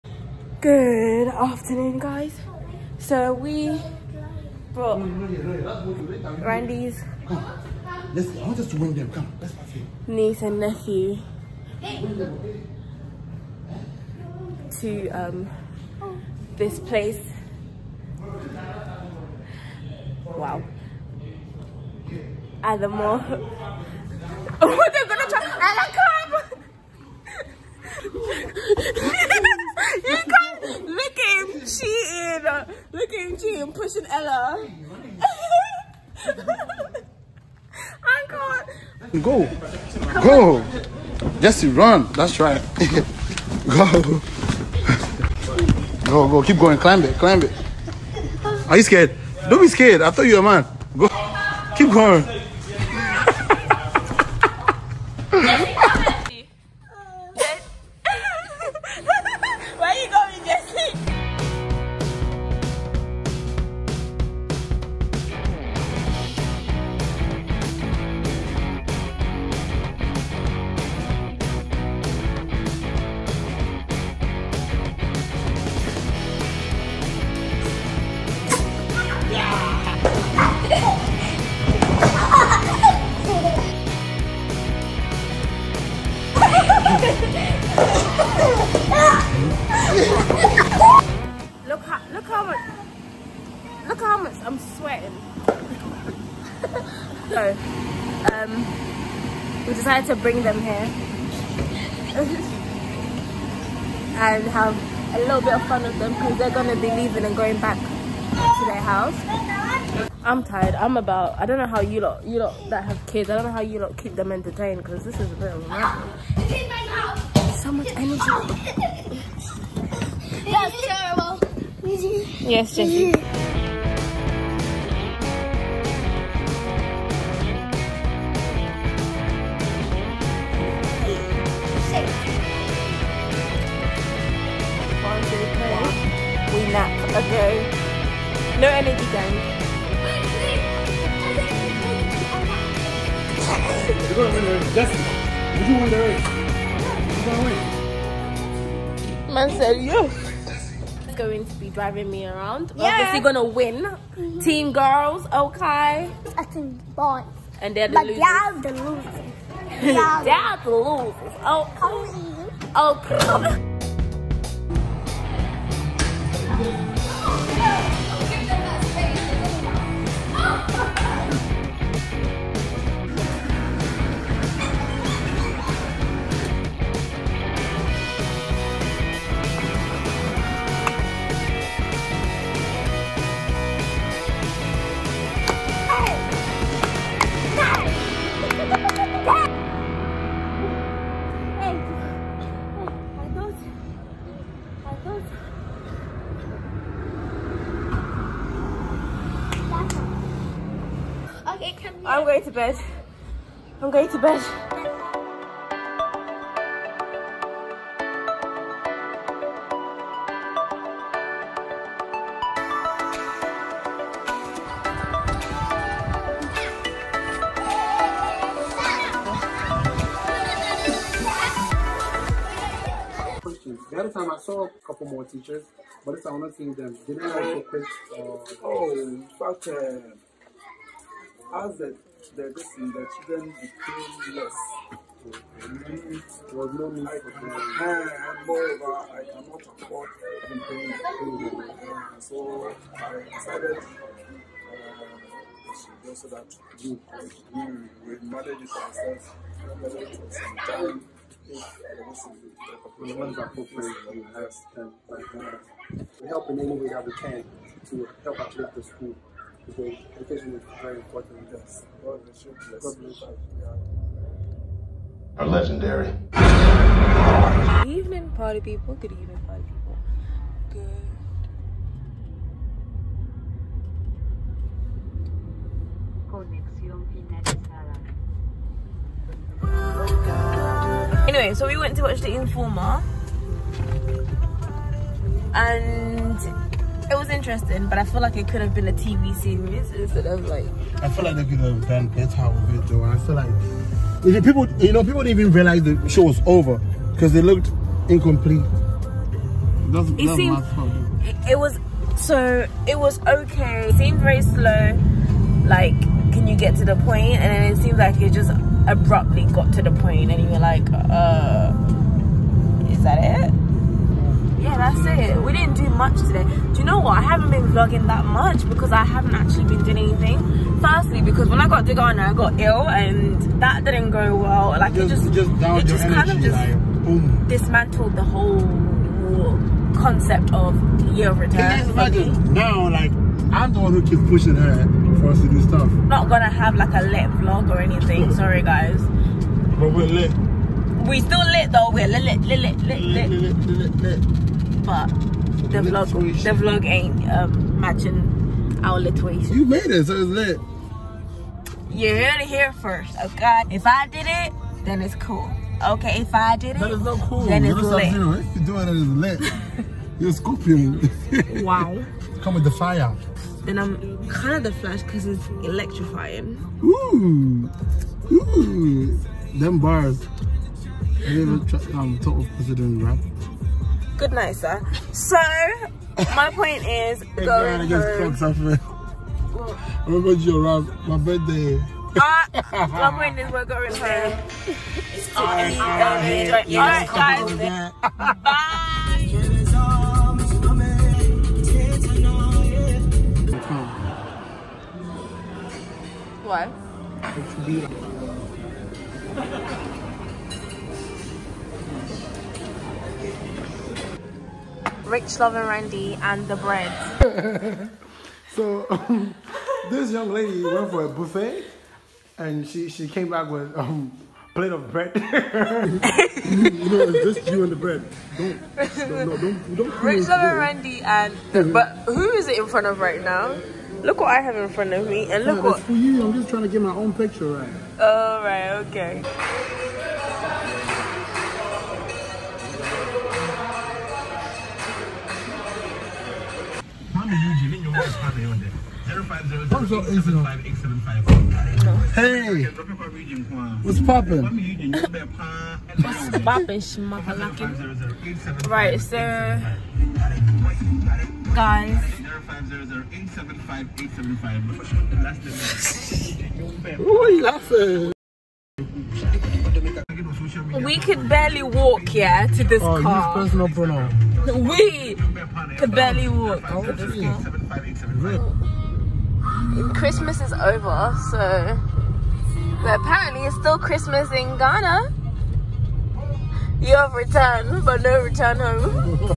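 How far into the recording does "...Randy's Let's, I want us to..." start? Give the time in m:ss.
0:06.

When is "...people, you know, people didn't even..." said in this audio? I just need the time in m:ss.
4:54.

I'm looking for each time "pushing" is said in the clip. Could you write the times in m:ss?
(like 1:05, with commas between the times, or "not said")
0:33, 5:34.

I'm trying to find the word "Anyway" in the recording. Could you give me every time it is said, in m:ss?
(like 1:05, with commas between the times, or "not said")
4:41.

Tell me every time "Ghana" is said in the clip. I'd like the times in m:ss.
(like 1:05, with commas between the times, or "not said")
5:21, 7:54.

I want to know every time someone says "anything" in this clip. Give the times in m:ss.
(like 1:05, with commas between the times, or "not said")
4:00, 5:19, 5:37.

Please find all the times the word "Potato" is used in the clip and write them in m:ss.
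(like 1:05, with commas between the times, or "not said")
not said.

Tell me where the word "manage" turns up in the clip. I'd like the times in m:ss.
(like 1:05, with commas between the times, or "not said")
4:08.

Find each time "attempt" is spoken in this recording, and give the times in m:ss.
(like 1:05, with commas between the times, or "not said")
not said.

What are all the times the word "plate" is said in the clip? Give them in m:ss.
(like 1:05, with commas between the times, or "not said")
6:54.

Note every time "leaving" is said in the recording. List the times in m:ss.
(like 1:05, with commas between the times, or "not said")
1:46.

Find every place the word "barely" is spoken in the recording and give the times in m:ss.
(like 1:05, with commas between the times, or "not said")
7:41, 7:45.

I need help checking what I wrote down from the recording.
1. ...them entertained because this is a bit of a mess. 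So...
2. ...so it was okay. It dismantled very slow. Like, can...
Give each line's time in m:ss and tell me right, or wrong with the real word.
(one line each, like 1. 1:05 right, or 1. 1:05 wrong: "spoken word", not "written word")
1. 1:54 right
2. 5:02 wrong: "seemed", not "dismantled".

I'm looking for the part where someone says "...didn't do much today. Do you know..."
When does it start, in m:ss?
5:15.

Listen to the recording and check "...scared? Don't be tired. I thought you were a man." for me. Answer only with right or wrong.
wrong.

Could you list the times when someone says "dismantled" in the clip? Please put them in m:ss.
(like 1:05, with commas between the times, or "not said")
5:27.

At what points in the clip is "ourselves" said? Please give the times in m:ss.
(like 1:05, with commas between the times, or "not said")
4:08.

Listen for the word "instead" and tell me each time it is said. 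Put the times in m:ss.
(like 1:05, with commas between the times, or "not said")
4:49.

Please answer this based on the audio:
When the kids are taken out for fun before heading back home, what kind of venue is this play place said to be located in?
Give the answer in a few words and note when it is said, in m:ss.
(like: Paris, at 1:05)
the mall, at 0:22.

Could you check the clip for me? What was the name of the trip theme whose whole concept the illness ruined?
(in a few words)
Year of Return.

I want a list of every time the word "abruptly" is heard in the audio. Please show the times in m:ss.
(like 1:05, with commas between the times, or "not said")
5:08.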